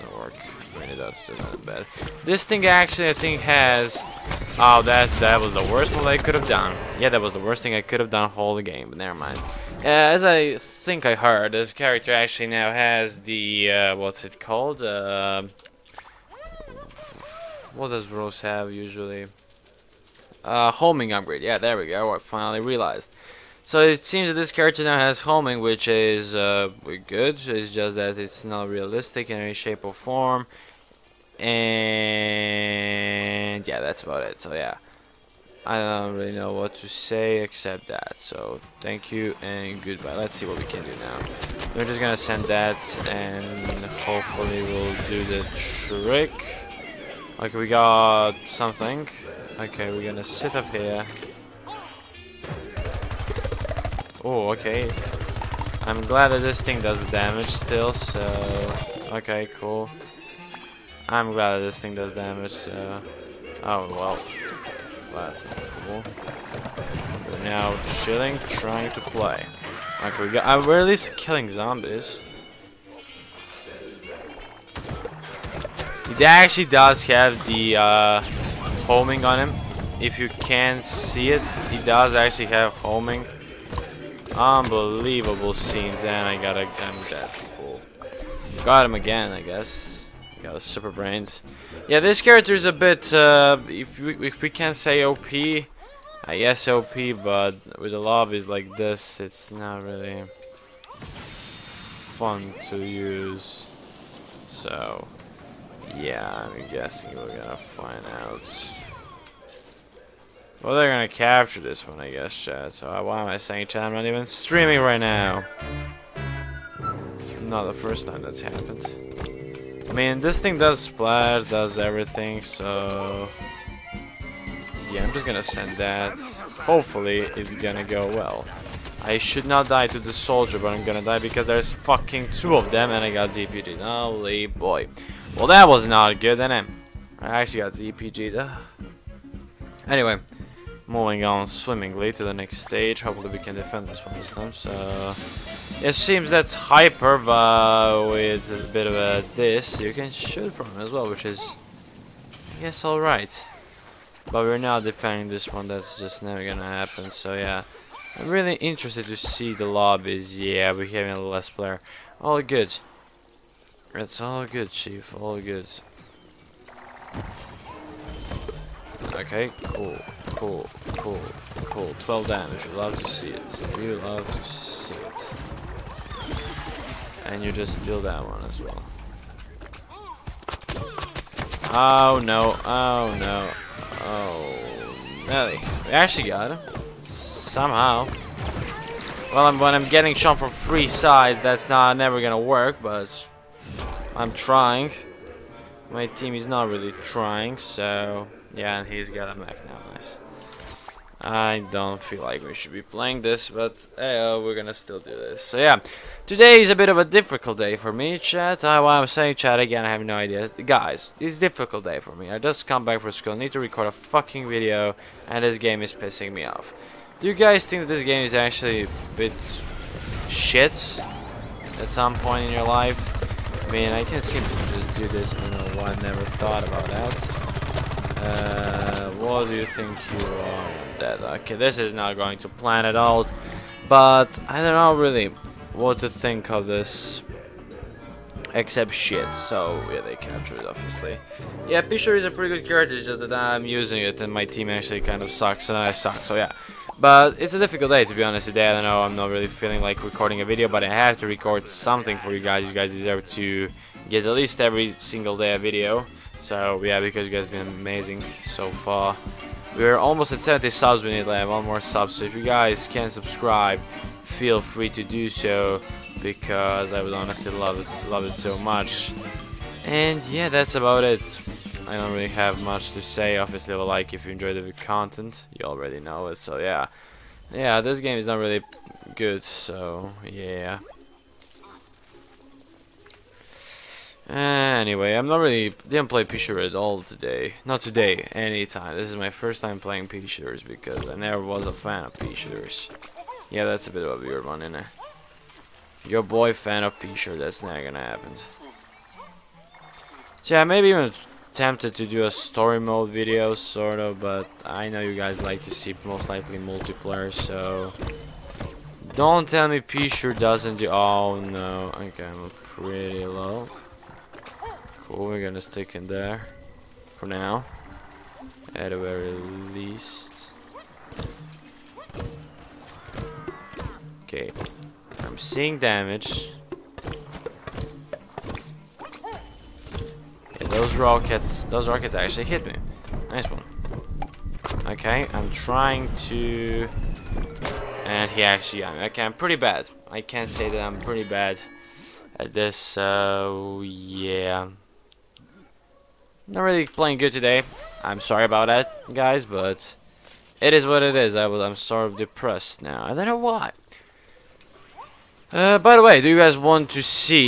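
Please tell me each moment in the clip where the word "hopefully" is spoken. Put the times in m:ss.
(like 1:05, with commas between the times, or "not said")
0:44, 2:06, 2:23.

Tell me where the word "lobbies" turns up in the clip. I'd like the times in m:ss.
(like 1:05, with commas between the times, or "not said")
1:37, 2:39.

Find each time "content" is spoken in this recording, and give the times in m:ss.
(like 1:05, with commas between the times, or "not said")
4:34.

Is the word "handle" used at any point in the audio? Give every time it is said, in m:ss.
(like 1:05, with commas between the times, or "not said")
not said.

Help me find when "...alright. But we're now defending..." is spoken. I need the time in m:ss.
2:32.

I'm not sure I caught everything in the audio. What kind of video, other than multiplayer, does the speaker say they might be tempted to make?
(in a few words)
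Story mode.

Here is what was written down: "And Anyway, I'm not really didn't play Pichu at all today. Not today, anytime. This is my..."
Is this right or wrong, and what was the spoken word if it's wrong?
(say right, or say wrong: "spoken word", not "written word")
right.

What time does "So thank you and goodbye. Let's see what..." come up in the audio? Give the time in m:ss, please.
0:38.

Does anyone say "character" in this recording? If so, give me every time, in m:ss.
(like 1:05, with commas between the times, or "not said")
0:11, 0:24, 1:32, 4:02.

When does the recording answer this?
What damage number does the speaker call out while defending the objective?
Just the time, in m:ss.
2:52.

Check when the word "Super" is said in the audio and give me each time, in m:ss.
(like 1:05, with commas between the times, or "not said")
1:30.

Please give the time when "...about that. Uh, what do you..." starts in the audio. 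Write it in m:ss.
3:46.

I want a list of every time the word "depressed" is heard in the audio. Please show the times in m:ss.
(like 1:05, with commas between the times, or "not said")
5:52.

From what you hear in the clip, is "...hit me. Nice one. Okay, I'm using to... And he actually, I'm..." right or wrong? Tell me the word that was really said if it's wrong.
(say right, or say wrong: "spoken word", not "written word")
wrong: "trying", not "using".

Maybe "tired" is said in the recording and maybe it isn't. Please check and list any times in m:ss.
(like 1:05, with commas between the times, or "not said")
not said.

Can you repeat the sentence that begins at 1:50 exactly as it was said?
Well, they're gonna capture this one, I guess, Chad.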